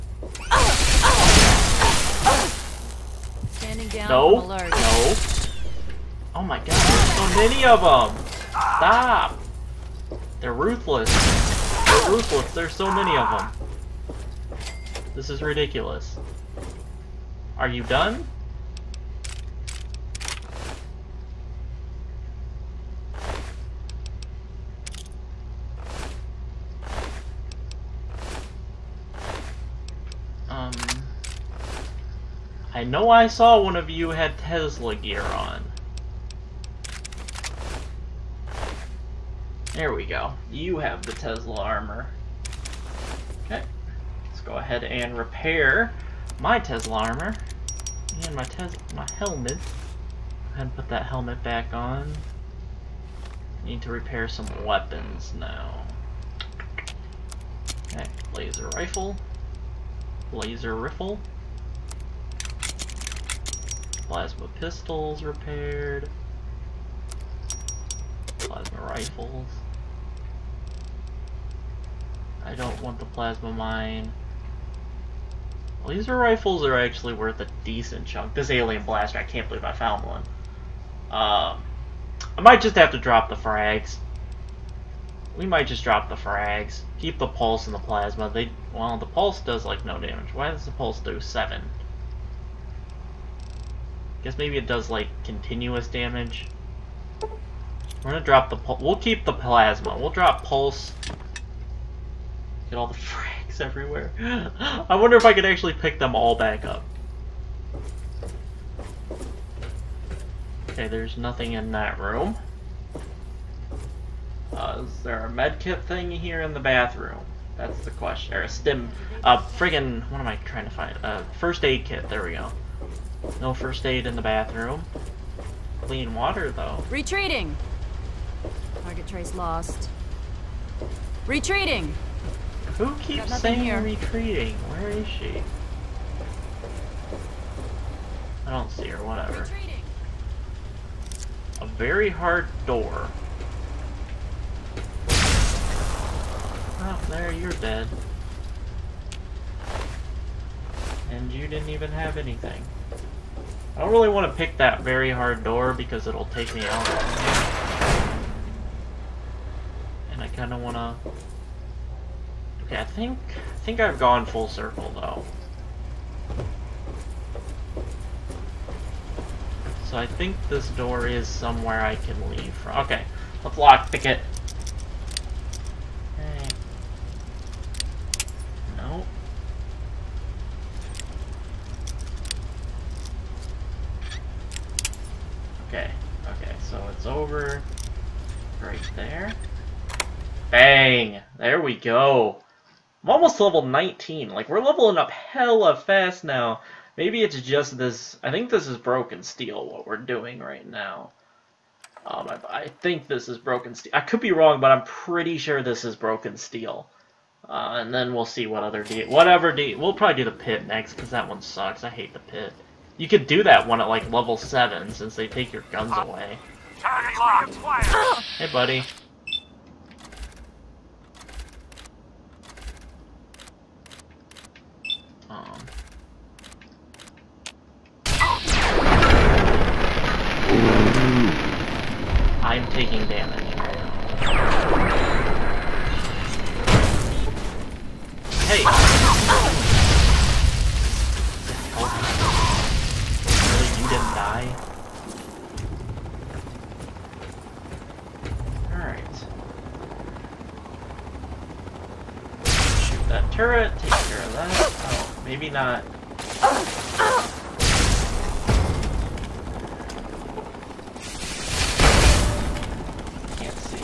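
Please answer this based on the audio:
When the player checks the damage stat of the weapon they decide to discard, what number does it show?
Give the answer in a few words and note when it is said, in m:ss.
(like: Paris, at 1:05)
7, at 1:31.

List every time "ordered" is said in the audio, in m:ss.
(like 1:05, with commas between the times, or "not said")
not said.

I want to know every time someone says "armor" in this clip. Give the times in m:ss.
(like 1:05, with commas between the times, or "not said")
0:41, 0:46.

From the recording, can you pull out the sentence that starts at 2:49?
So I think this door is somewhere I can leave from.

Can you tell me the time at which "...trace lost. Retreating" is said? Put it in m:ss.
2:09.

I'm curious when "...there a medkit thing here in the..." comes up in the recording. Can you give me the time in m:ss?
1:55.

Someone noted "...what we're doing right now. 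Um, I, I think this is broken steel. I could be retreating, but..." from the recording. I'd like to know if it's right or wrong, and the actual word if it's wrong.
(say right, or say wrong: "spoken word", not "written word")
wrong: "wrong", not "retreating".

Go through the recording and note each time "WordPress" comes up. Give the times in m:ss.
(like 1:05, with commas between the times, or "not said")
not said.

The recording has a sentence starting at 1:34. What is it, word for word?
Guess maybe it does like continuous damage.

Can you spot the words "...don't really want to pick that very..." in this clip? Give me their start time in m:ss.
2:33.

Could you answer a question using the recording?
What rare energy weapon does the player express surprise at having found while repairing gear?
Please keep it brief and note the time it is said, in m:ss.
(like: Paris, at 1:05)
alien blaster, at 1:18.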